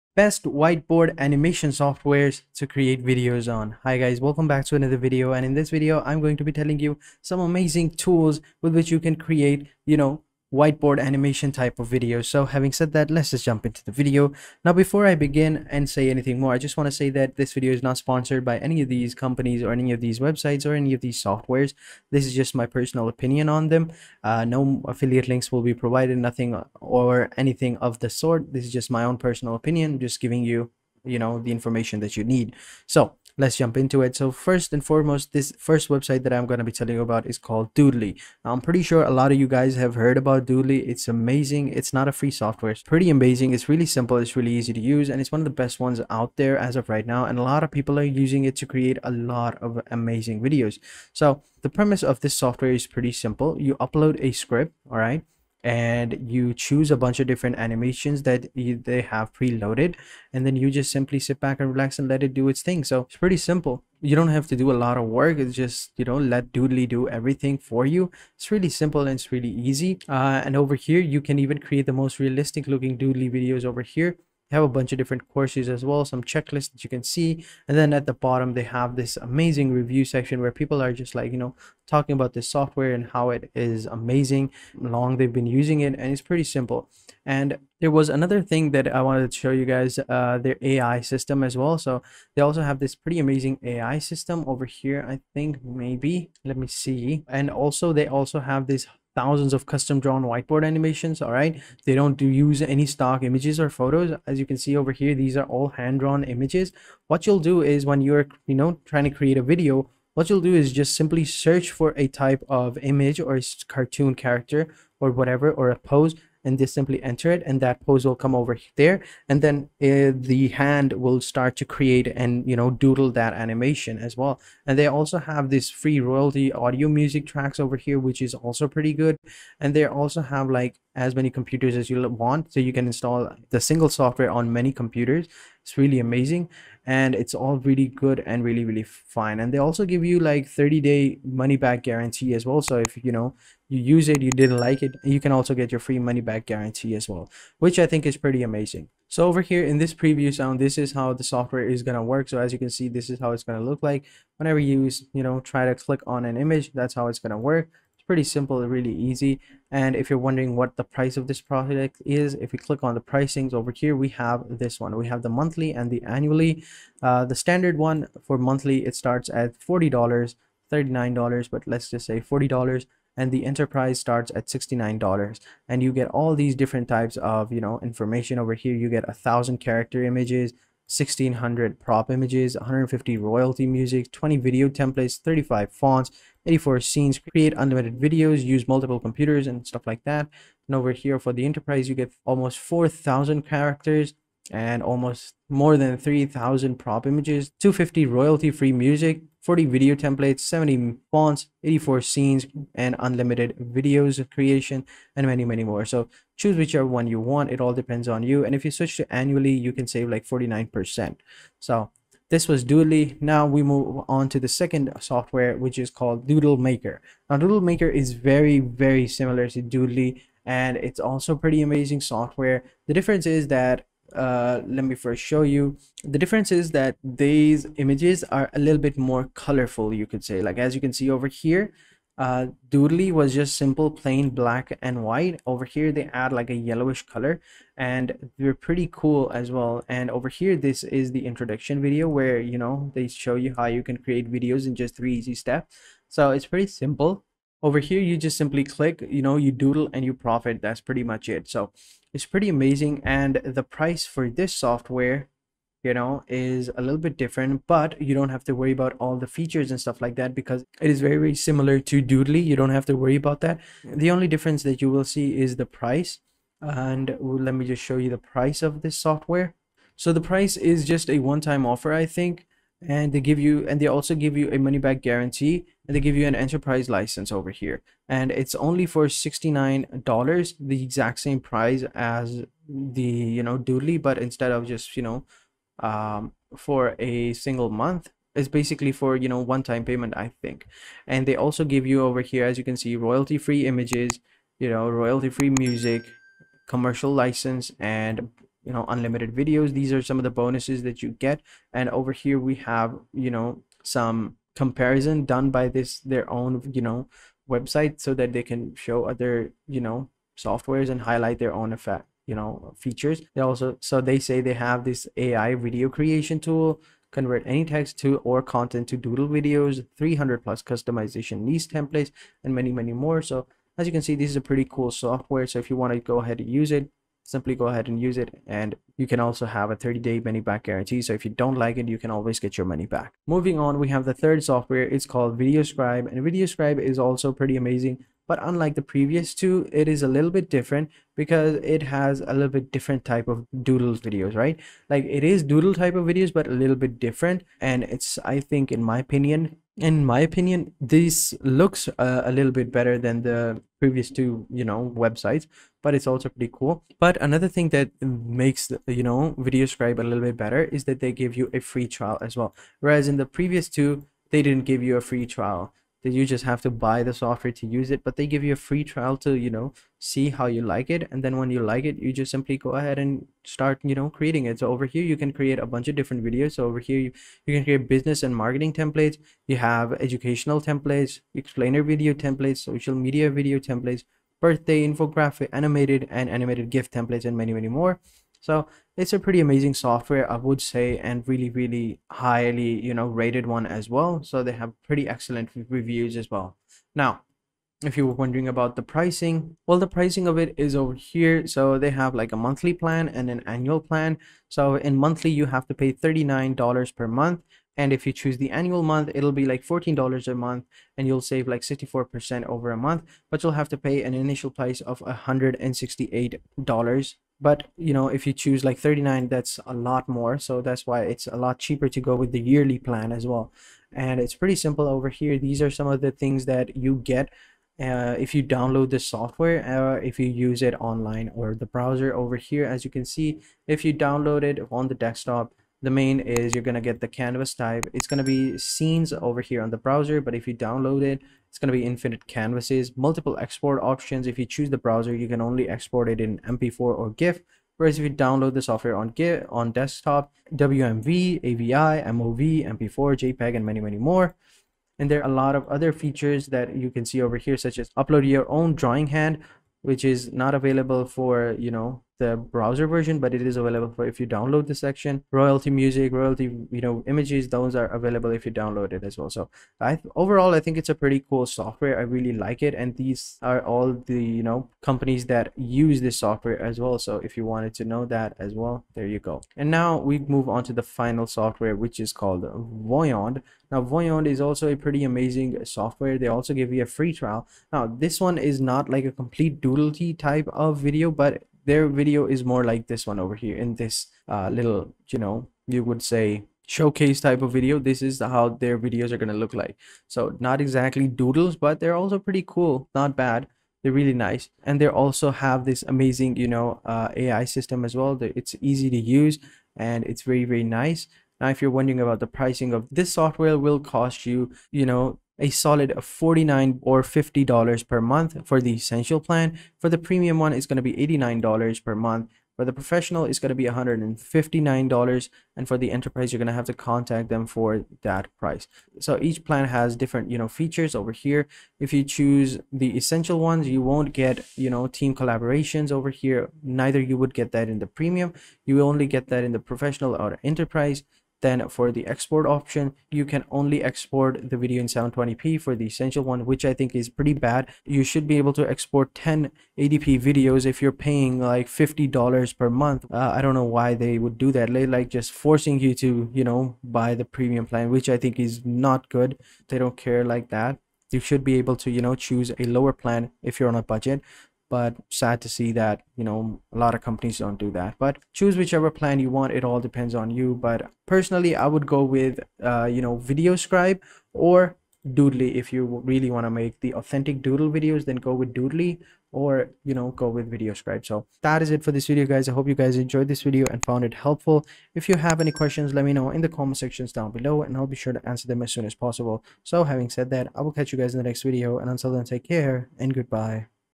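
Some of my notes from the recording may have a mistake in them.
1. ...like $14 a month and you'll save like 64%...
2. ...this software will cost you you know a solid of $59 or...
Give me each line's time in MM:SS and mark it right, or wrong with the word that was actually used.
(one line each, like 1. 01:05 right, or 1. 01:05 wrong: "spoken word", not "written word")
1. 06:49 right
2. 08:32 wrong: "49", not "59".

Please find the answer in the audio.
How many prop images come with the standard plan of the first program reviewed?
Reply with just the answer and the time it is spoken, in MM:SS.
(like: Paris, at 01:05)
1600, at 03:00.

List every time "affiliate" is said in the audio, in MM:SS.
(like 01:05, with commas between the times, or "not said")
00:24.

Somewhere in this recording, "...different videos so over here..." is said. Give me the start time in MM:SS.
06:15.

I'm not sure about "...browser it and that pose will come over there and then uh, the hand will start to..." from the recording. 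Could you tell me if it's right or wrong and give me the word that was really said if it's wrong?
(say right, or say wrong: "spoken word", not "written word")
wrong: "enter", not "browser".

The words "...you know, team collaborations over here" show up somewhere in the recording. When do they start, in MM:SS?
08:54.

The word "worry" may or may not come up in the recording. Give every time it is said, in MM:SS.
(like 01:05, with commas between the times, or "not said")
04:18, 04:22.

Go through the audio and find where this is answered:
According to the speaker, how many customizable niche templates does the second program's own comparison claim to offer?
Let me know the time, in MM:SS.
05:19.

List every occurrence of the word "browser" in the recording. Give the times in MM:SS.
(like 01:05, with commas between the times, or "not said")
07:11, 07:19, 07:24, 07:42.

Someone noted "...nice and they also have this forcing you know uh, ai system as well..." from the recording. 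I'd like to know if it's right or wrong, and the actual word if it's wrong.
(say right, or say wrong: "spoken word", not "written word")
wrong: "amazing", not "forcing".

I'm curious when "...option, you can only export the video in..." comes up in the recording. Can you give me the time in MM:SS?
09:02.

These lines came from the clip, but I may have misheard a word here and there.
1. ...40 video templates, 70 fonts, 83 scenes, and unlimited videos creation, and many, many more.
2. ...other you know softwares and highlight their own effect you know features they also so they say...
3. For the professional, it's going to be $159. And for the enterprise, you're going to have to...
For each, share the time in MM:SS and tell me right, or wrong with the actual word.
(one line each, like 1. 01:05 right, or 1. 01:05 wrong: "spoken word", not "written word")
1. 03:19 wrong: "84", not "83"
2. 05:09 right
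3. 08:42 right.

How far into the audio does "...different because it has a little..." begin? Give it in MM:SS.
05:40.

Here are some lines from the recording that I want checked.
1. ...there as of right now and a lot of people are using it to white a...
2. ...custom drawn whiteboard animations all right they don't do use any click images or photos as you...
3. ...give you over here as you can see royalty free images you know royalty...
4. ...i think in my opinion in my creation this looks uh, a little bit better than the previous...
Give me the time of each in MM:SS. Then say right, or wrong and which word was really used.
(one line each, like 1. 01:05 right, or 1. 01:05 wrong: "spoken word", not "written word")
1. 00:46 wrong: "create", not "white"
2. 01:39 wrong: "stock", not "click"
3. 04:51 right
4. 05:48 wrong: "opinion", not "creation".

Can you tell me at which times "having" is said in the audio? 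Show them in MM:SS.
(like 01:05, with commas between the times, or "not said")
00:12, 09:49.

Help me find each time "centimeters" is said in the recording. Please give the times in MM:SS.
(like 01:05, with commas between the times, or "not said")
not said.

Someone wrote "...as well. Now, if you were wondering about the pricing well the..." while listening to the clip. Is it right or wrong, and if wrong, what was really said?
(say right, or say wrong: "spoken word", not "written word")
right.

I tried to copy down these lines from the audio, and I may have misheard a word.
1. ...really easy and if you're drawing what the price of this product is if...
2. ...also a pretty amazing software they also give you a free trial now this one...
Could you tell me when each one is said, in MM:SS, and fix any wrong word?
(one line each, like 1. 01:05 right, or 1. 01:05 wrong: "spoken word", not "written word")
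1. 02:38 wrong: "wondering", not "drawing"
2. 08:04 right.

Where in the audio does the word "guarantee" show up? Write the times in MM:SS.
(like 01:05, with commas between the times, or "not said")
02:21, 02:26, 04:35, 05:30.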